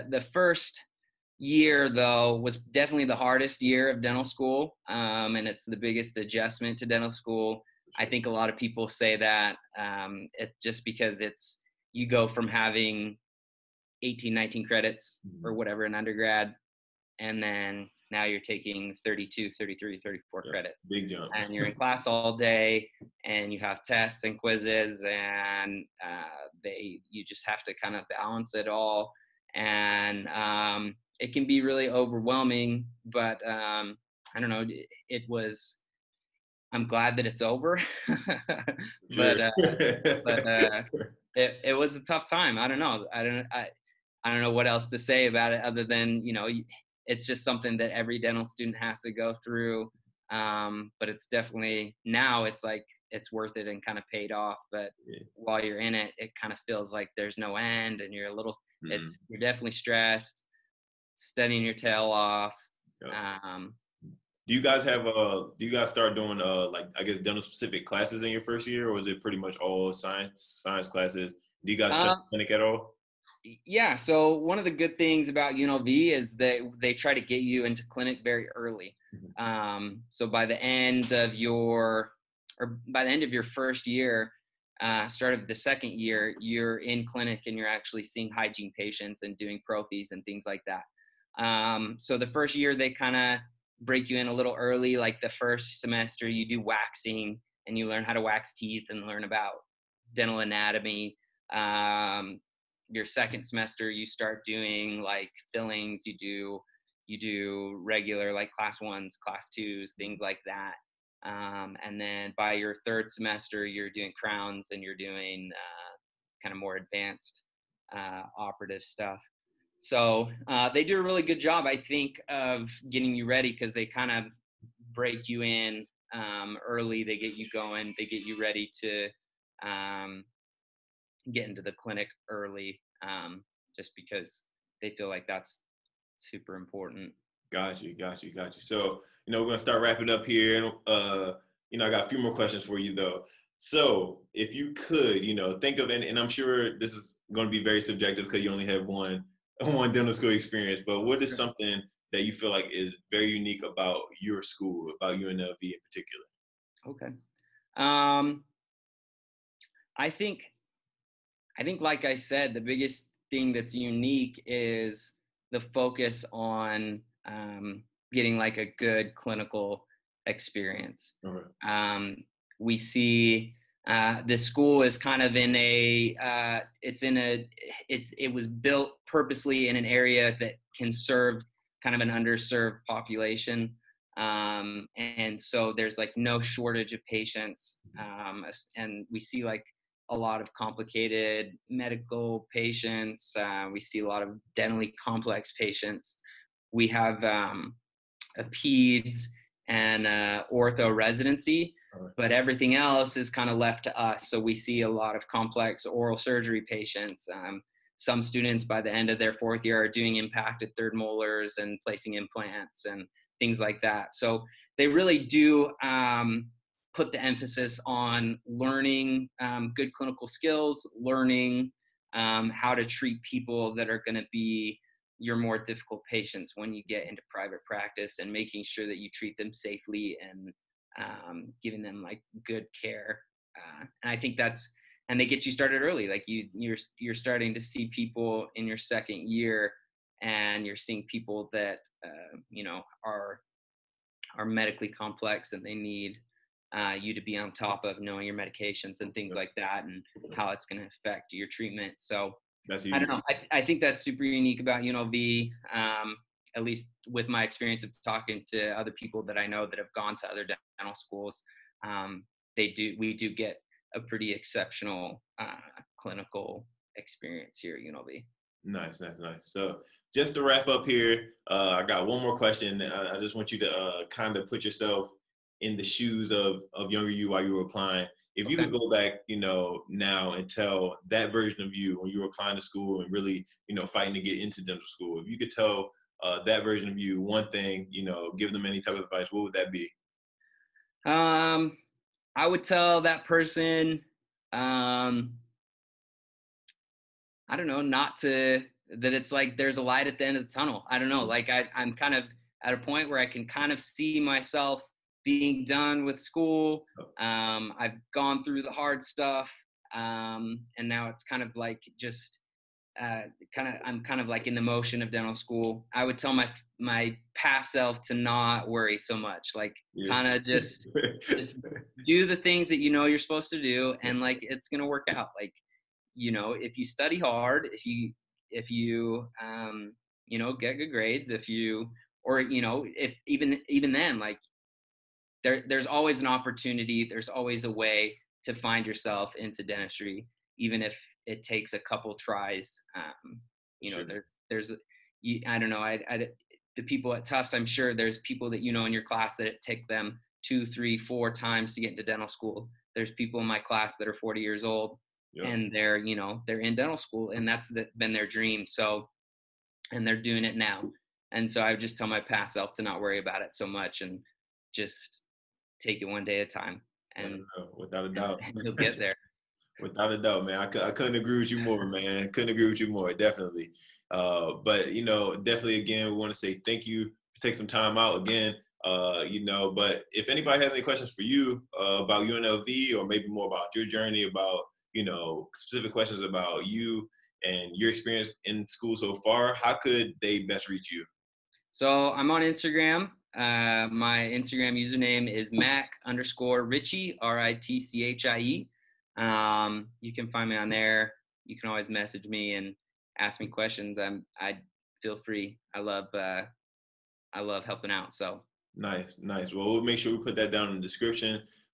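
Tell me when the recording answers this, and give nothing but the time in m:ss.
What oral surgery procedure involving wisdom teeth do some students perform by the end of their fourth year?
3:30.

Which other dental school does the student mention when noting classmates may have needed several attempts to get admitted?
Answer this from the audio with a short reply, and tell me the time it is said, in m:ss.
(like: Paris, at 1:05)
Tufts, at 5:47.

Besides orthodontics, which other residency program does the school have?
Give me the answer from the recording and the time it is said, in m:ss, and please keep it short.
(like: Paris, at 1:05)
Peds, at 3:18.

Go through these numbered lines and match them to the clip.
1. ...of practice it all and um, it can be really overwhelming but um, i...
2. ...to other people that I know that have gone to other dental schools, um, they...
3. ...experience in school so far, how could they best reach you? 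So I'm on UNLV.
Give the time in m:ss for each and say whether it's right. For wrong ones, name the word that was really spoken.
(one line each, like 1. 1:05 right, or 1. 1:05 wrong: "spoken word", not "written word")
1. 0:27 wrong: "balance", not "practice"
2. 4:18 right
3. 6:27 wrong: "Instagram", not "UNLV".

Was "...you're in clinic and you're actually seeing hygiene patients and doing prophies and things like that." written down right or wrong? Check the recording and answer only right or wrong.
right.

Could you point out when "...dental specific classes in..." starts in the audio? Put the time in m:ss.
1:07.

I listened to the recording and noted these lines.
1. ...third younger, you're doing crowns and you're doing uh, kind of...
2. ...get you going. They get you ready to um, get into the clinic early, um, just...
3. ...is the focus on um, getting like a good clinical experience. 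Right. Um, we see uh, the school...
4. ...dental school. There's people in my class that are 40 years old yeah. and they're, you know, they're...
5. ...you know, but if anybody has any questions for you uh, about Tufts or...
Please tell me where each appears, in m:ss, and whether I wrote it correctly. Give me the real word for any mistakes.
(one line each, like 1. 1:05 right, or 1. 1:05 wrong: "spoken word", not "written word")
1. 1:52 wrong: "semester", not "younger"
2. 2:07 right
3. 2:44 right
4. 5:52 right
5. 6:19 wrong: "UNLV", not "Tufts".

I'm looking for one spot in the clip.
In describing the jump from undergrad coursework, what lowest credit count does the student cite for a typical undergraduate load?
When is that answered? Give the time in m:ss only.
0:14.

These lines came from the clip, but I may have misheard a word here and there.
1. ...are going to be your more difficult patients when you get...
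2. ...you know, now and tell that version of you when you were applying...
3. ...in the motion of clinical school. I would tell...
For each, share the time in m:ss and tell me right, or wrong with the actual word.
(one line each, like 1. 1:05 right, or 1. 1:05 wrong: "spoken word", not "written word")
1. 3:43 right
2. 4:39 right
3. 5:14 wrong: "dental", not "clinical".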